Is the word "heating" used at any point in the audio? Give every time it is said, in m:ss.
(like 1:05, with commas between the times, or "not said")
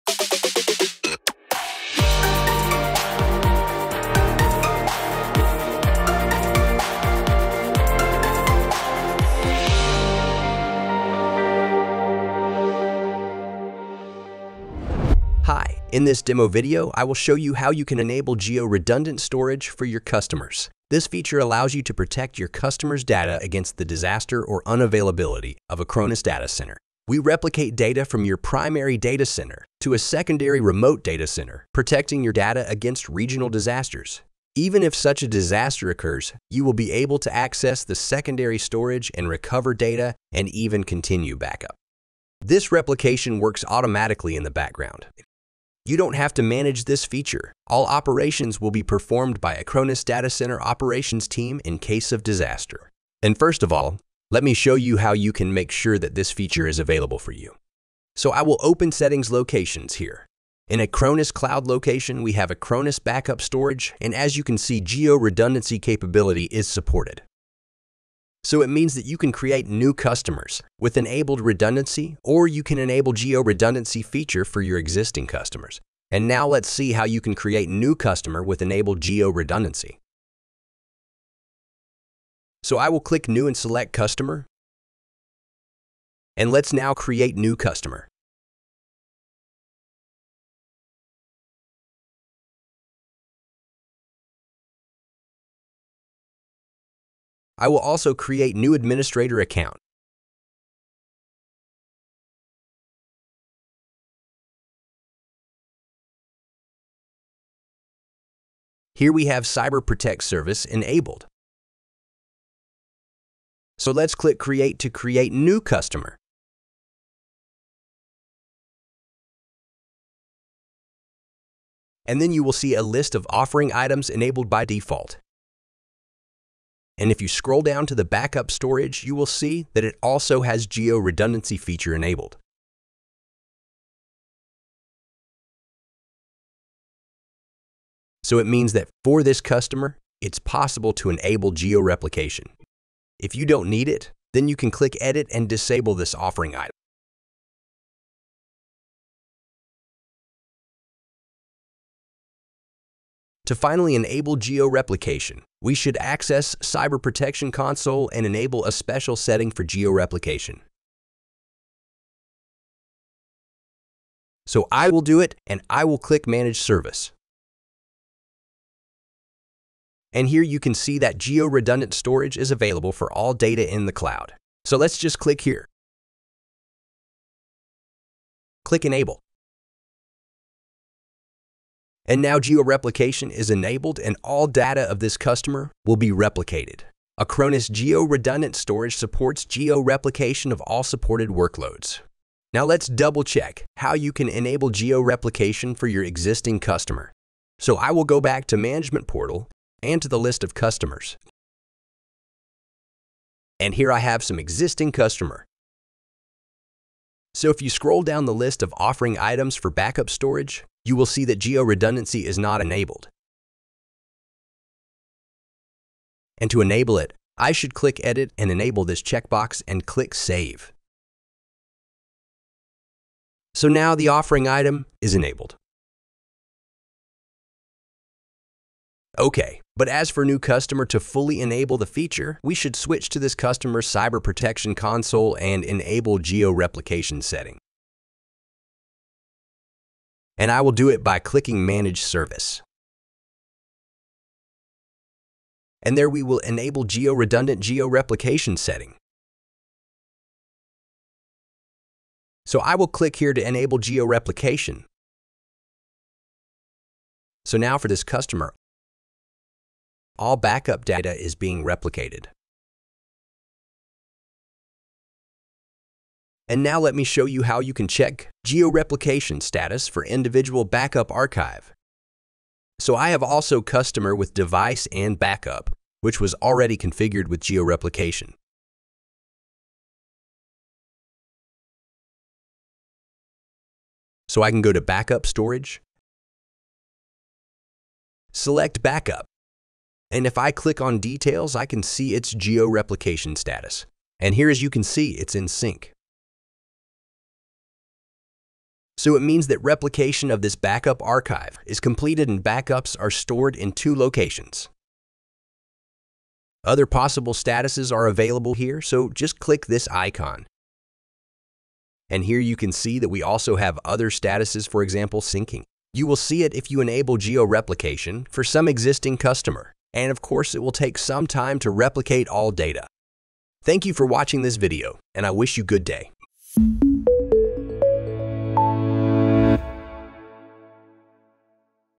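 not said.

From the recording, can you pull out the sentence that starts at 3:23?
And here I have some existing customer.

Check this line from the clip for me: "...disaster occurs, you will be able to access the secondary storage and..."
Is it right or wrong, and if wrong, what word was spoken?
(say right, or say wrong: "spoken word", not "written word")
right.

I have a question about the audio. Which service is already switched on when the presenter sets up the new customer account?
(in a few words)
Cyber Protect.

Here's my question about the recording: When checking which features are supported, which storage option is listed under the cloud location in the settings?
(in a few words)
Acronis Backup Storage.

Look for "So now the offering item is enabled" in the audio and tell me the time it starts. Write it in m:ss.
3:43.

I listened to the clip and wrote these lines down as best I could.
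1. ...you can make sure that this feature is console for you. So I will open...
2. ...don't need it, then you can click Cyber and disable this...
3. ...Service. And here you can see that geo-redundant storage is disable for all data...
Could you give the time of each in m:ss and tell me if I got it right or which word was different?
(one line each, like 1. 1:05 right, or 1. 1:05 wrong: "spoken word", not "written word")
1. 0:55 wrong: "available", not "console"
2. 2:23 wrong: "Edit", not "Cyber"
3. 2:46 wrong: "available", not "disable".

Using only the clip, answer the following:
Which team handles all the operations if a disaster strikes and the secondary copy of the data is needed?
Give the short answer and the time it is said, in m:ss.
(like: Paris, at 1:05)
Acronis Data Center operations team, at 0:49.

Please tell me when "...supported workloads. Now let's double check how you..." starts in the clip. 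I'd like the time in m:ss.
3:10.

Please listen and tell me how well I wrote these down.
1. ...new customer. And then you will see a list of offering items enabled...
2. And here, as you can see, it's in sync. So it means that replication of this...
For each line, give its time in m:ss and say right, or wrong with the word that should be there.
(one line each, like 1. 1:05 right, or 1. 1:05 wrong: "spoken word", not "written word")
1. 1:55 right
2. 4:54 right.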